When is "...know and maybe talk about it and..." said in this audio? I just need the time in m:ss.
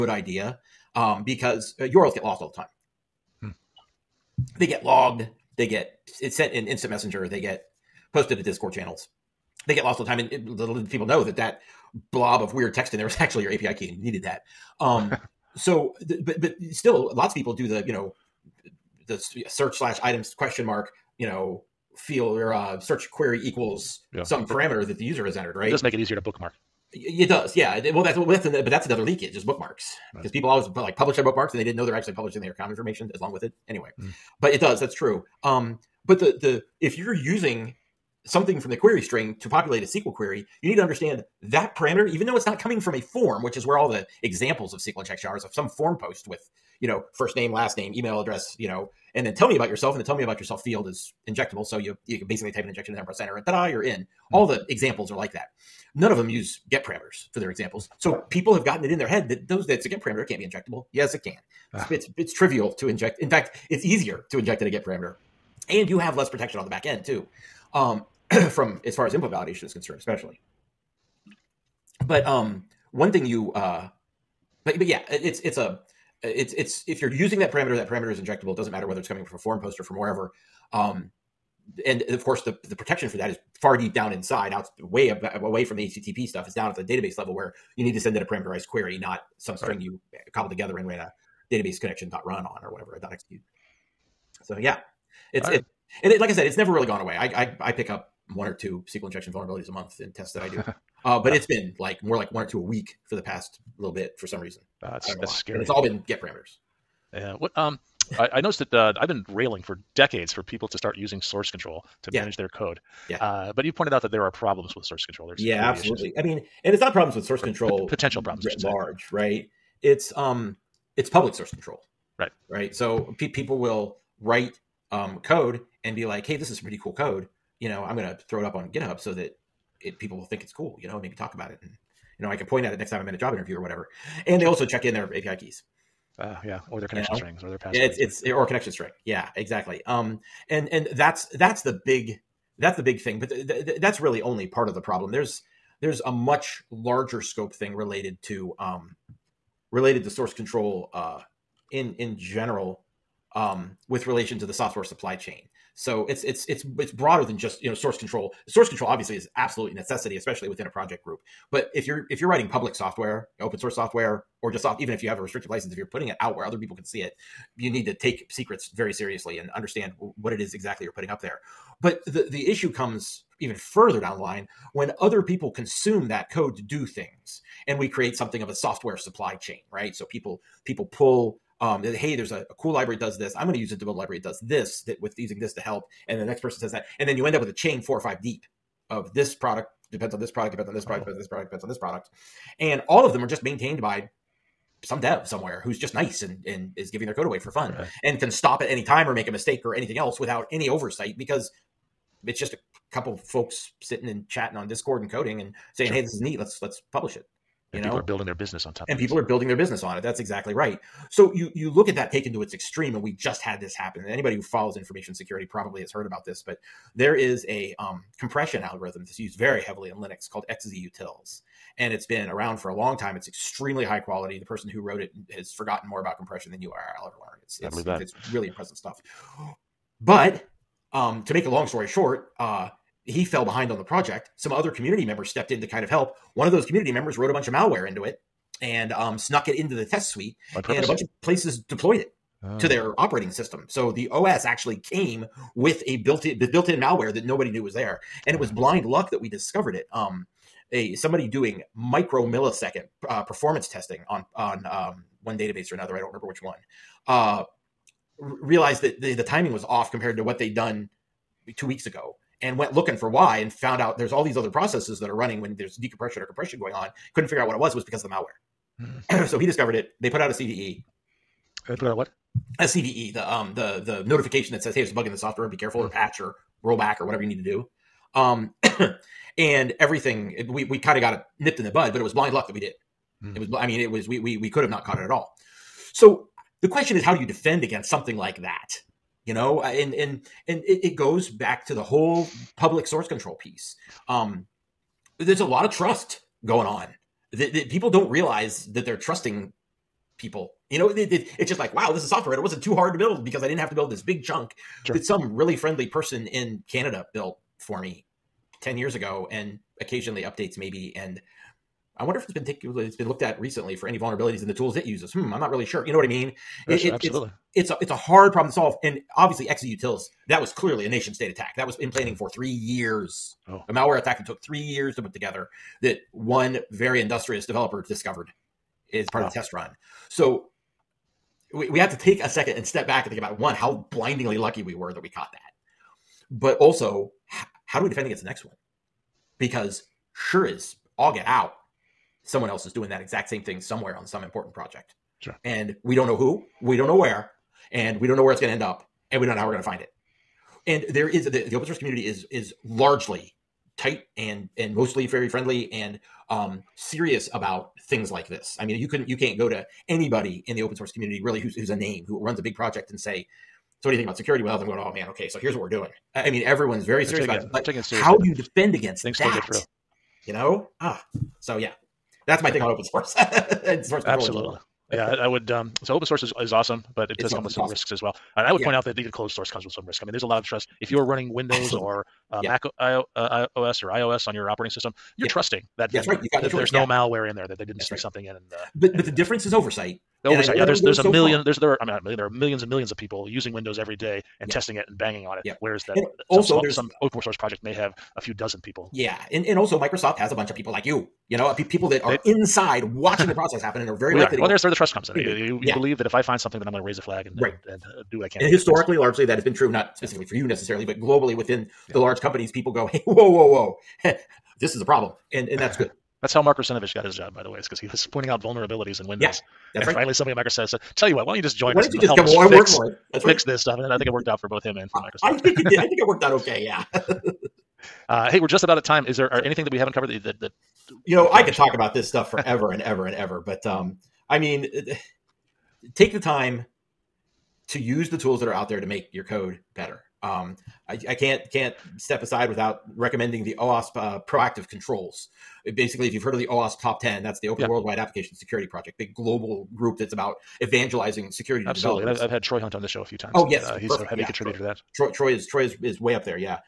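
2:10.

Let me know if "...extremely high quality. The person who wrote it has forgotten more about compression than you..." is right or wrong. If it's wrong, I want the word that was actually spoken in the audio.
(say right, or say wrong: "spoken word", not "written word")
right.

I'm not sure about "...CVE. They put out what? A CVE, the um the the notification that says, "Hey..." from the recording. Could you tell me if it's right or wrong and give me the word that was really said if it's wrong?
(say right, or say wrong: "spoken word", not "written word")
right.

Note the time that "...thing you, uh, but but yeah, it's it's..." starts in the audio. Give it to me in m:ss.
1:13.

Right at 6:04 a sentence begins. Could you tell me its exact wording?
Well, them going, oh man, okay, so here's what we're doing.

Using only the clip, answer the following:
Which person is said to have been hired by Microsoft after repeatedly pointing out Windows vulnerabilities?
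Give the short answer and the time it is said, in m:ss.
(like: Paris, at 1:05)
Mark Russinovich, at 6:56.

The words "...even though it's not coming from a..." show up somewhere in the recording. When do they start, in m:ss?
0:42.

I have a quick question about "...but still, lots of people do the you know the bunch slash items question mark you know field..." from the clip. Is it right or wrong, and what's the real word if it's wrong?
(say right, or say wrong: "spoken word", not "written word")
wrong: "search", not "bunch".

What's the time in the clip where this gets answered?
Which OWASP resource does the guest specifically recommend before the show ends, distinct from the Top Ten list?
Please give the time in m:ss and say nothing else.
7:24.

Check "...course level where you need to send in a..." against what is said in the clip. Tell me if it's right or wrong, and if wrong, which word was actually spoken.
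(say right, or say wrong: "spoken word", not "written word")
wrong: "database", not "course".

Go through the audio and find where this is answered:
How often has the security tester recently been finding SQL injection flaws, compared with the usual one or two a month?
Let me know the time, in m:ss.
1:42.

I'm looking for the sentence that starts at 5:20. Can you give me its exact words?
That was clearly a nation state attack.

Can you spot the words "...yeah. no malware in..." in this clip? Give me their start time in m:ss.
6:26.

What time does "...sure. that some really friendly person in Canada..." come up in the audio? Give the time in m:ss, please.
5:04.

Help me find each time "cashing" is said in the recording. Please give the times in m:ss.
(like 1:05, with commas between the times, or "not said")
not said.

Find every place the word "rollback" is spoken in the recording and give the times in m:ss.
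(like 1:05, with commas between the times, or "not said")
4:36.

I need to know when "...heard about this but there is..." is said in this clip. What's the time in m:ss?
3:35.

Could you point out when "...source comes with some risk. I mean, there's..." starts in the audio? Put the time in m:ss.
6:19.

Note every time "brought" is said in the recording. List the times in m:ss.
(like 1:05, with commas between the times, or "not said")
not said.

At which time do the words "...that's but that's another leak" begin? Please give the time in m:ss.
0:28.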